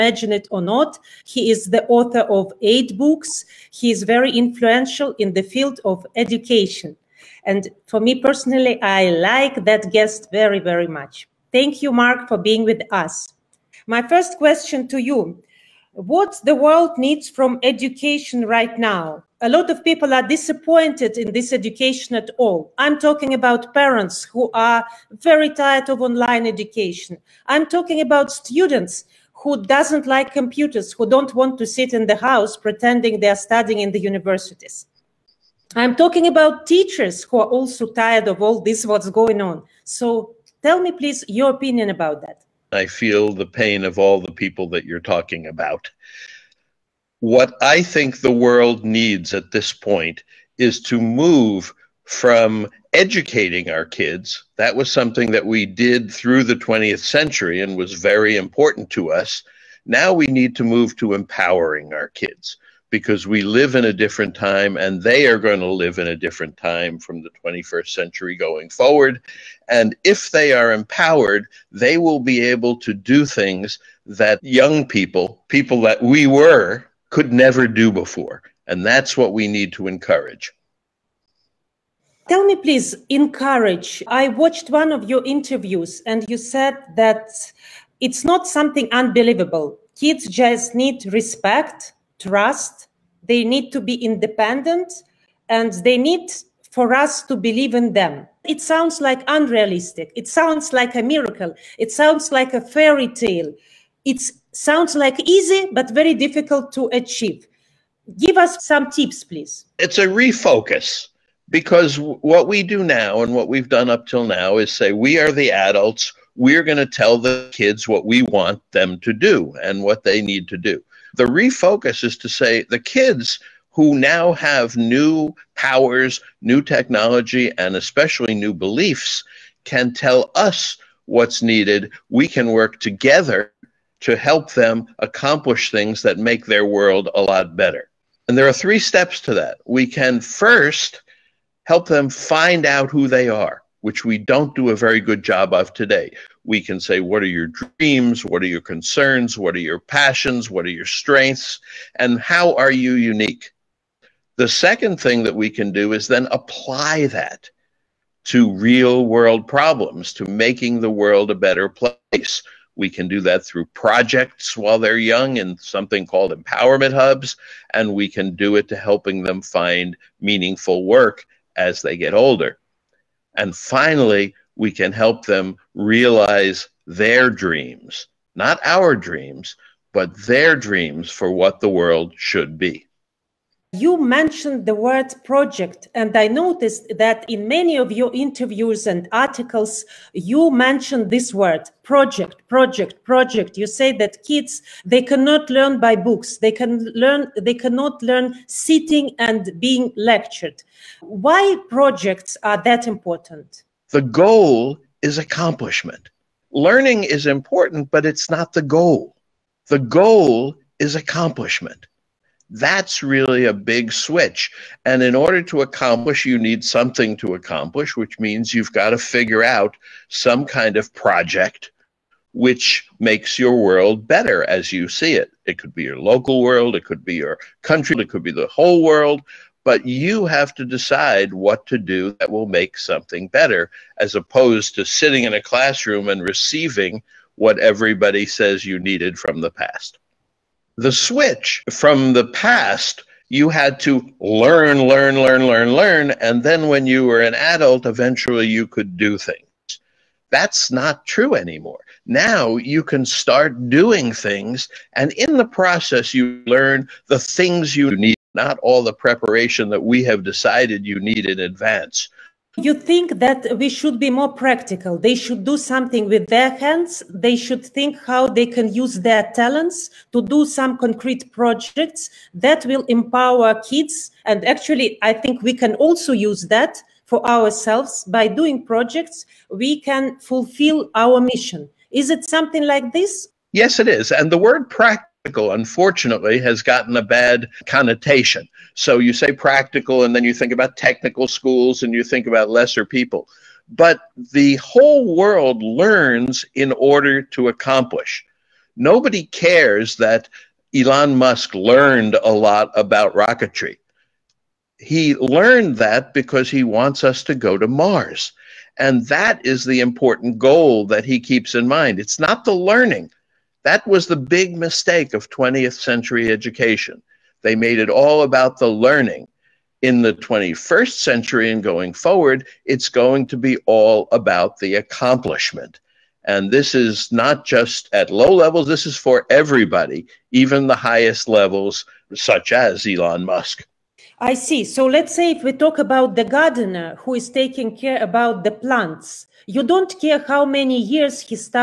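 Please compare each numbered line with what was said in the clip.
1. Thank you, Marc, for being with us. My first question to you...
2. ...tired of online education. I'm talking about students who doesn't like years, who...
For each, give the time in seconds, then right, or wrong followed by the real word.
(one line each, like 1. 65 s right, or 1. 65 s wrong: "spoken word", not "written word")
1. 11 s right
2. 25 s wrong: "computers", not "years".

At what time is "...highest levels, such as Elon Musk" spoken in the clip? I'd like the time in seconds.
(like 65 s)
330 s.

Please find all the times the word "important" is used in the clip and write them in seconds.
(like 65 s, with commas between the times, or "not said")
58 s, 202 s, 207 s, 309 s.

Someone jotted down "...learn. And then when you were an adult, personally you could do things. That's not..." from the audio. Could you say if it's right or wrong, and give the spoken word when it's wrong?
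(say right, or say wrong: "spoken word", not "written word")
wrong: "eventually", not "personally".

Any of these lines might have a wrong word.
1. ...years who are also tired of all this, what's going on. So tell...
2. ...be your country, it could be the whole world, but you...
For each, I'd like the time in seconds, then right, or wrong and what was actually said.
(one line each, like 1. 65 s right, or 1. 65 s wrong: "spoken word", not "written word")
1. 36 s wrong: "teachers", not "years"
2. 227 s right.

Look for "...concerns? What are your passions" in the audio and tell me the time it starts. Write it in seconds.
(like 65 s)
148 s.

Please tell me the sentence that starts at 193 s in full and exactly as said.
You say that kids, they cannot learn by books.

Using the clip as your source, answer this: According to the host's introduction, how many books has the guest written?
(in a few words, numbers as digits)
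8.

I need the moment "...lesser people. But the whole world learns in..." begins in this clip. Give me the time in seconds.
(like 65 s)
292 s.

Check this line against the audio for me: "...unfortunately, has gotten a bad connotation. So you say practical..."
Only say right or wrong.
right.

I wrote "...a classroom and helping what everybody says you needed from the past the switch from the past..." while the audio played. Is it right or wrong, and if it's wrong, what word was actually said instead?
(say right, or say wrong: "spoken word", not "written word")
wrong: "receiving", not "helping".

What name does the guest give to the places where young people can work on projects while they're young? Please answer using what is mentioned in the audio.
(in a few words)
empowerment hubs.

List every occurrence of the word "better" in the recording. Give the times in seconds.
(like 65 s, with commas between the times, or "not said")
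137 s, 161 s, 224 s, 233 s.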